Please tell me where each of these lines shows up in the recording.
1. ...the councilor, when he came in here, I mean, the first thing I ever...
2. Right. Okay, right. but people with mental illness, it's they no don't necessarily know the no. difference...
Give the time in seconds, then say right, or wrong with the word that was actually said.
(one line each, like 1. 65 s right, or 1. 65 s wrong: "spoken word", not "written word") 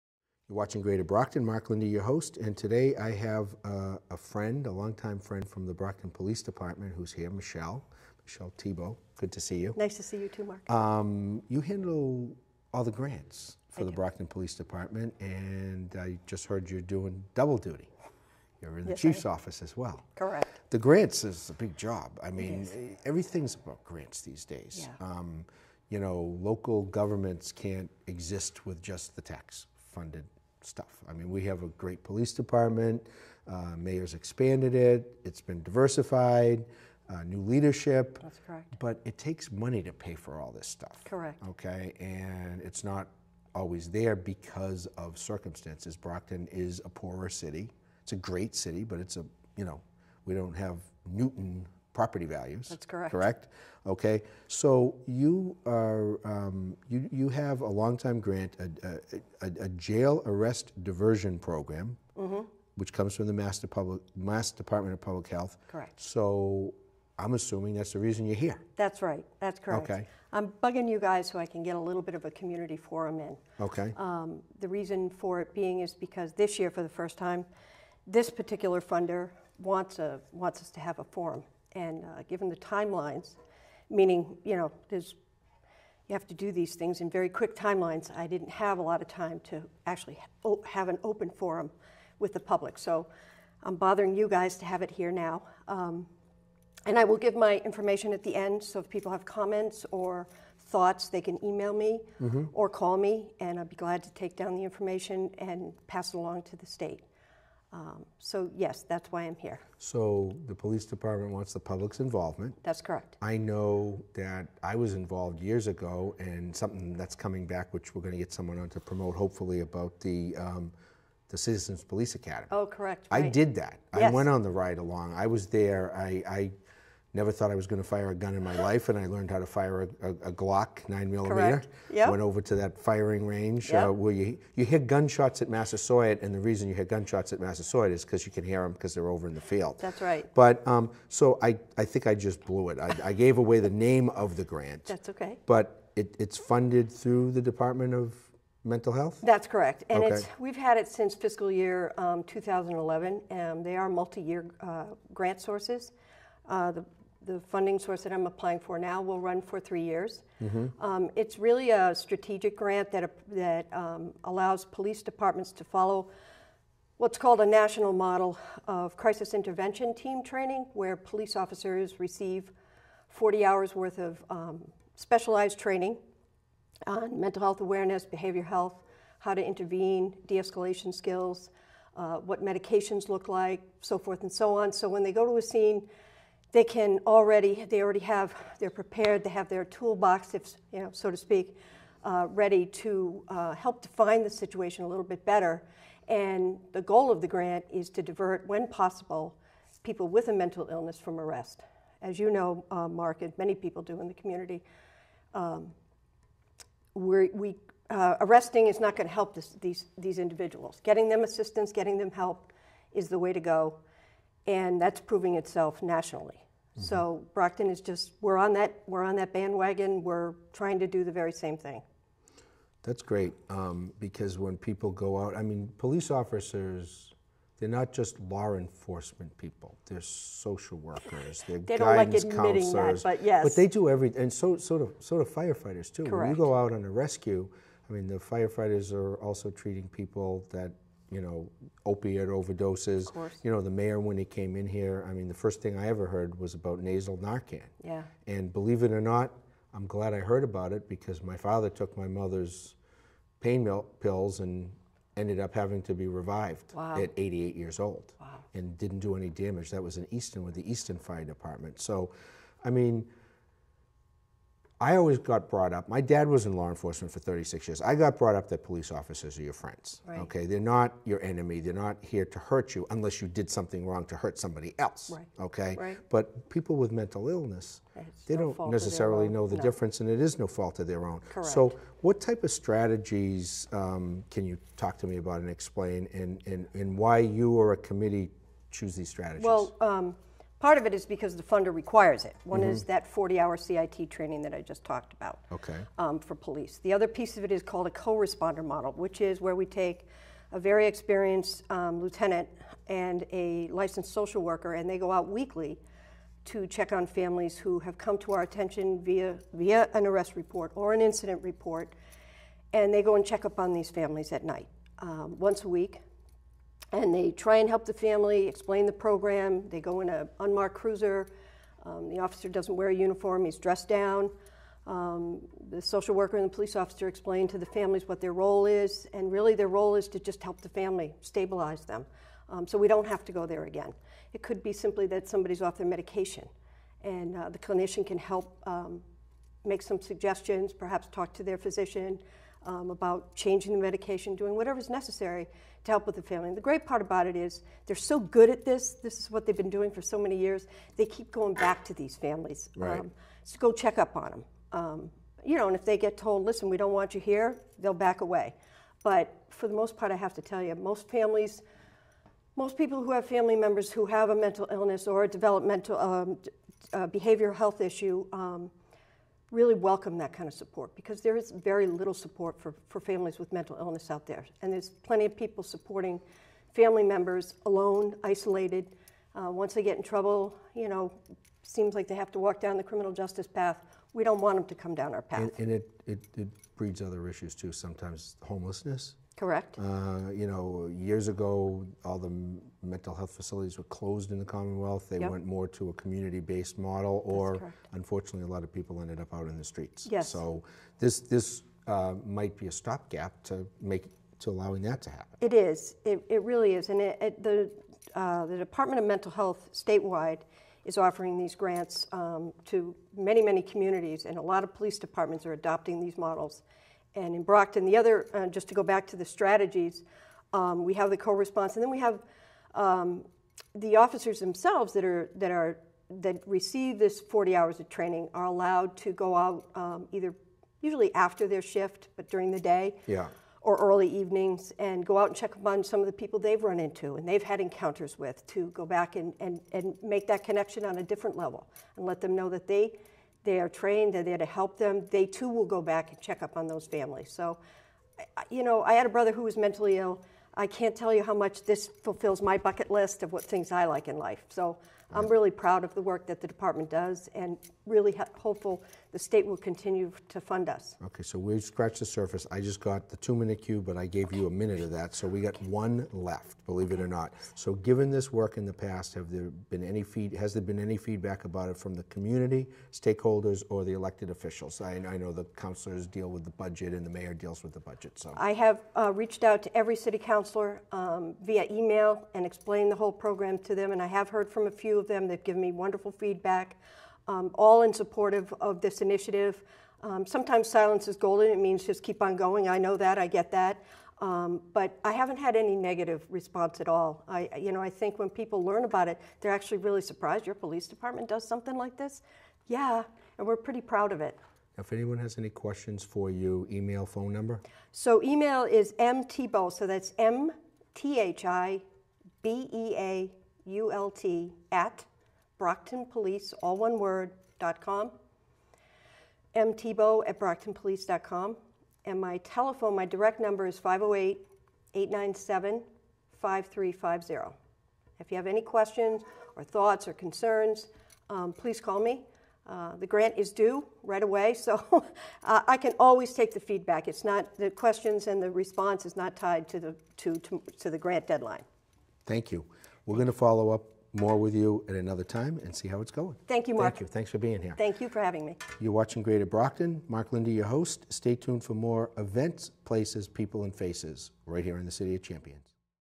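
1. 243 s wrong: "mayor", not "councilor"
2. 275 s right.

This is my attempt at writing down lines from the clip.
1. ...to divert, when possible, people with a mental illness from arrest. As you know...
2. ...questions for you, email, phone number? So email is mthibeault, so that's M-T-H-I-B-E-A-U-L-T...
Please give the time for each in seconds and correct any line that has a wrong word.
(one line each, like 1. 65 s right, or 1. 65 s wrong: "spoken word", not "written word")
1. 197 s right
2. 505 s right.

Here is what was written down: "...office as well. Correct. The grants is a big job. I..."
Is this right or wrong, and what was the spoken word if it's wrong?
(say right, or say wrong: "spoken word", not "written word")
right.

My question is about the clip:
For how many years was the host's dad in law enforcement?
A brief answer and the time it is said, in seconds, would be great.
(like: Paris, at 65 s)
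36, at 267 s.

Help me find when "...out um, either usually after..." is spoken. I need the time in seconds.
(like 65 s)
429 s.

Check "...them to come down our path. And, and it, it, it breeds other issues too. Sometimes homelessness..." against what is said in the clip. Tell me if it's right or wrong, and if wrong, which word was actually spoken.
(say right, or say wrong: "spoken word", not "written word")
right.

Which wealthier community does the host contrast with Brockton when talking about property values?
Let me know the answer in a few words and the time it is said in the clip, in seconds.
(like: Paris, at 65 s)
Newton, at 51 s.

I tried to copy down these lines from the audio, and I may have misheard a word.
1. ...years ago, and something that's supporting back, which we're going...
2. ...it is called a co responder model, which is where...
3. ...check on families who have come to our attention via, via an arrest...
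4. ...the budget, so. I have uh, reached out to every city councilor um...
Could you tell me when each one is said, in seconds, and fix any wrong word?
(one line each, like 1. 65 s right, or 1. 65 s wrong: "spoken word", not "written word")
1. 115 s wrong: "coming", not "supporting"
2. 297 s right
3. 306 s right
4. 477 s right.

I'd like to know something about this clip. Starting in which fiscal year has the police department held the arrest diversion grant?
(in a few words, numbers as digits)
2011.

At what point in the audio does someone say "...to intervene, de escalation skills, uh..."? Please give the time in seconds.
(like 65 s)
179 s.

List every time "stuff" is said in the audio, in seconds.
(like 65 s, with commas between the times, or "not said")
30 s, 40 s.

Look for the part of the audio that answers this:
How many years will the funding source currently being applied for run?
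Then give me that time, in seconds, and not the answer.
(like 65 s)
159 s.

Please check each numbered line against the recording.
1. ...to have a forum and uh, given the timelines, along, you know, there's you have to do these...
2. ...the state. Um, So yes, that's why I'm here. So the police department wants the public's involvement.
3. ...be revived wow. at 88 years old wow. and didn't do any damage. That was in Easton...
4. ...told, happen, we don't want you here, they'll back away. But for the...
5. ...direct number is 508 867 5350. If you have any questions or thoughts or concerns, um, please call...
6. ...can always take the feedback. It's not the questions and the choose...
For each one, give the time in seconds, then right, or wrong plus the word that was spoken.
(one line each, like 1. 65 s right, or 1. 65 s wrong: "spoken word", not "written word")
1. 80 s wrong: "meaning", not "along"
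2. 106 s right
3. 255 s right
4. 356 s wrong: "listen", not "happen"
5. 523 s wrong: "897", not "867"
6. 535 s wrong: "response", not "choose".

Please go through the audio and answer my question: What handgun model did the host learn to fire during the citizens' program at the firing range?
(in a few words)
Glock 9 millimeter.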